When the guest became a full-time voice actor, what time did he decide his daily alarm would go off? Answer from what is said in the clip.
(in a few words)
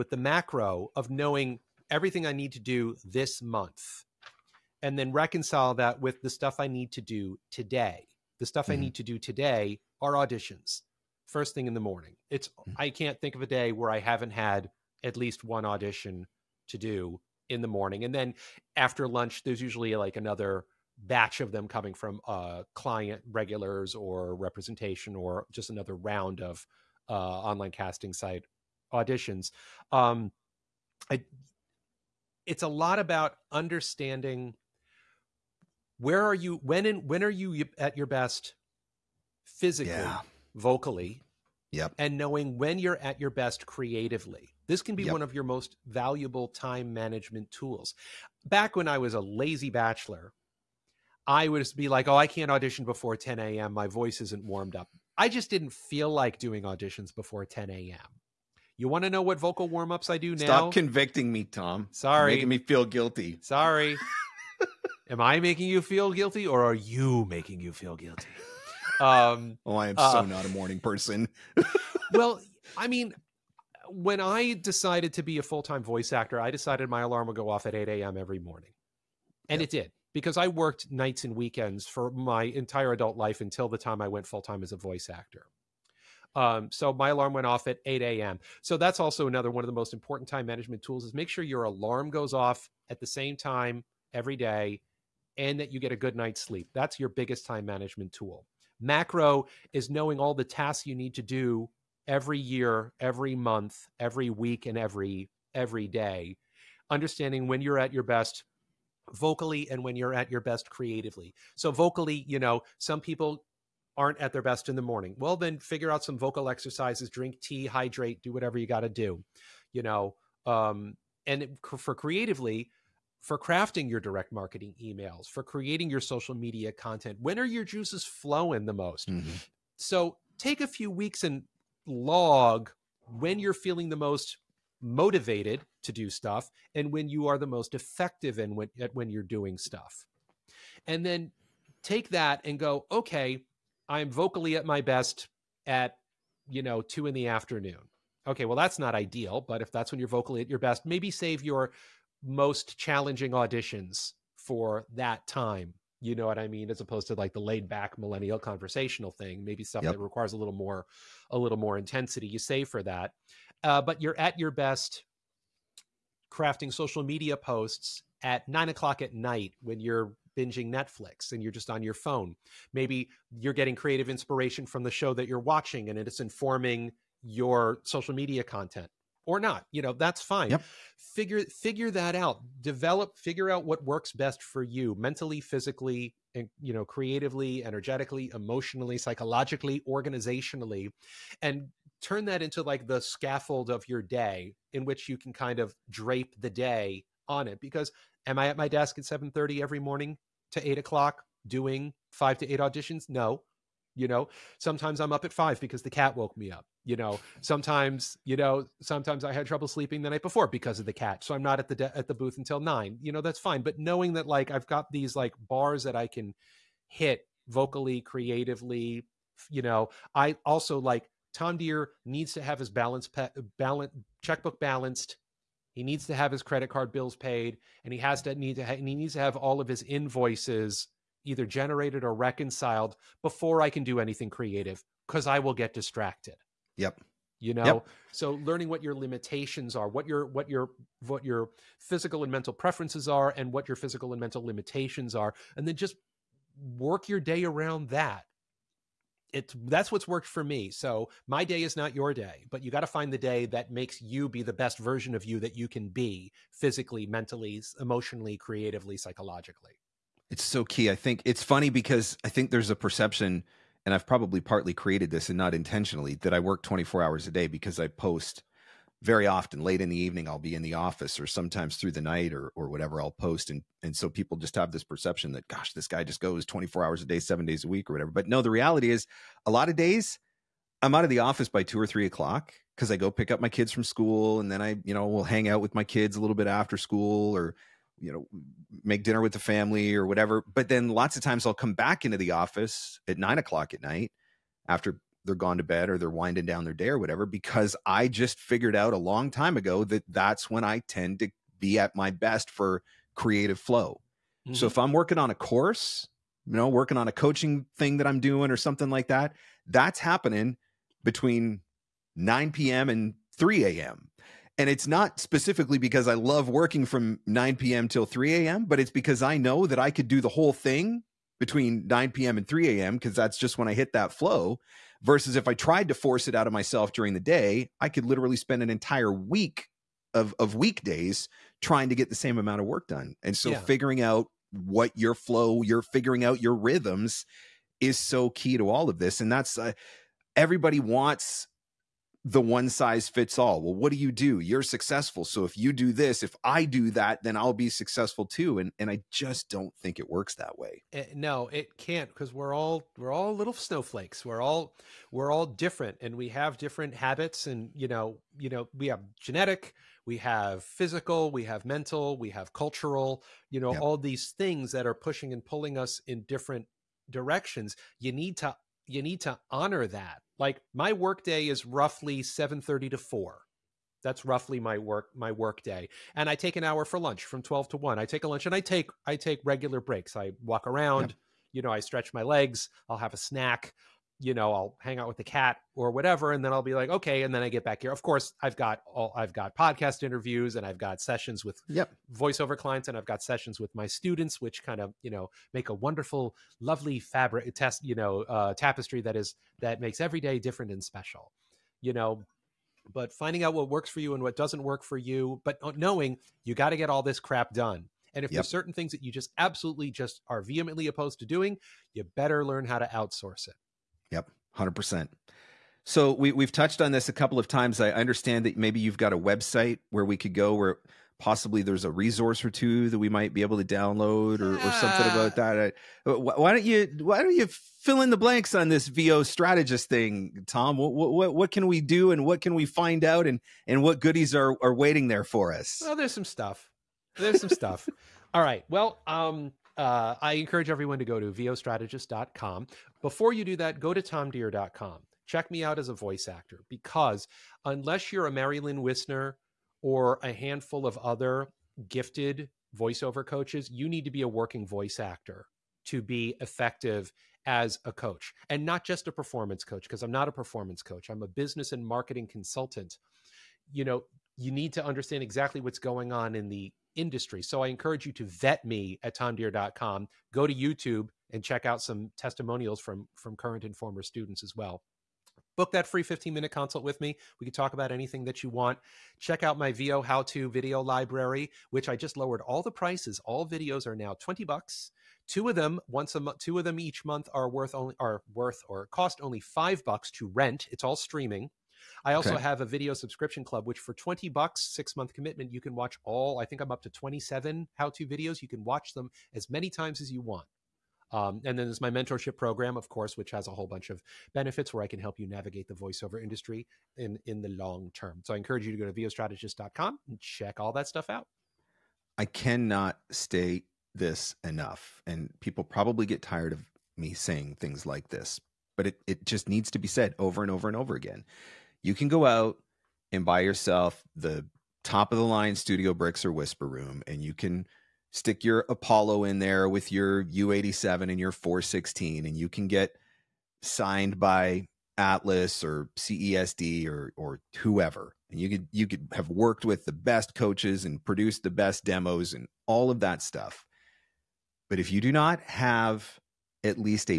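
8 a.m.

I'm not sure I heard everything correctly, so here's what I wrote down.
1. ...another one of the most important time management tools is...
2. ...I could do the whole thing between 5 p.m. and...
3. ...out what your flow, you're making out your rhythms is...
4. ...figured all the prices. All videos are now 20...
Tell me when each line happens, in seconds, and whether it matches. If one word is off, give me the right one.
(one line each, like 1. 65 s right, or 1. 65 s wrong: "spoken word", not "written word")
1. 89 s right
2. 319 s wrong: "9", not "5"
3. 334 s wrong: "figuring", not "making"
4. 482 s wrong: "lowered", not "figured".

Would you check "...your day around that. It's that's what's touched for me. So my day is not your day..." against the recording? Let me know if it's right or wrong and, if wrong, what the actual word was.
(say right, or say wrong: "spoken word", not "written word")
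wrong: "worked", not "touched".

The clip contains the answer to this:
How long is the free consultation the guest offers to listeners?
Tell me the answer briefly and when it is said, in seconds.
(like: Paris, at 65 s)
15 minutes, at 476 s.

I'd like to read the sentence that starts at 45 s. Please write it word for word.
one of your most valuable time management tools.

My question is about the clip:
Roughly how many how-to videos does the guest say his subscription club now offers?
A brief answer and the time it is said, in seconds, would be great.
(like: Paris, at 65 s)
27, at 496 s.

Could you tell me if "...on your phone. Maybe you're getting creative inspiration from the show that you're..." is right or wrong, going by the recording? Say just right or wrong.
right.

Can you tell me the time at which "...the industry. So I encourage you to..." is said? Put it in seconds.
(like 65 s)
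466 s.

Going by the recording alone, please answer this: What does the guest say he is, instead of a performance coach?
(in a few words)
Business and marketing consultant.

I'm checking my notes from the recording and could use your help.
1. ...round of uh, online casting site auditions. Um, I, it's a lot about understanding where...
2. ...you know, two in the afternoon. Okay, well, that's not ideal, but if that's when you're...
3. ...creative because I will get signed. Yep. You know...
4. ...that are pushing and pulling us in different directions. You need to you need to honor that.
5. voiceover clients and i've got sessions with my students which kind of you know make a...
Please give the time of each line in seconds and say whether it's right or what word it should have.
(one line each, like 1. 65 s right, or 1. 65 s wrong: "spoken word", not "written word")
1. 25 s right
2. 146 s right
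3. 234 s wrong: "distracted", not "signed"
4. 364 s right
5. 392 s right.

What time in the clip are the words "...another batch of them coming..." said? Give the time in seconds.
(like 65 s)
20 s.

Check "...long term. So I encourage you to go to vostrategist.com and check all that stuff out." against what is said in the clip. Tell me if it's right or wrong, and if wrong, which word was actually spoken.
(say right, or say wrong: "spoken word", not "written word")
right.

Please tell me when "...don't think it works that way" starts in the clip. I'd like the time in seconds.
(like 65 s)
349 s.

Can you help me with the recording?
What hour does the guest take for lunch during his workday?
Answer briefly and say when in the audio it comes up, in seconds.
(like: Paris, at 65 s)
12 to 1, at 377 s.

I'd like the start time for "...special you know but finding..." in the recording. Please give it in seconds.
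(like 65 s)
400 s.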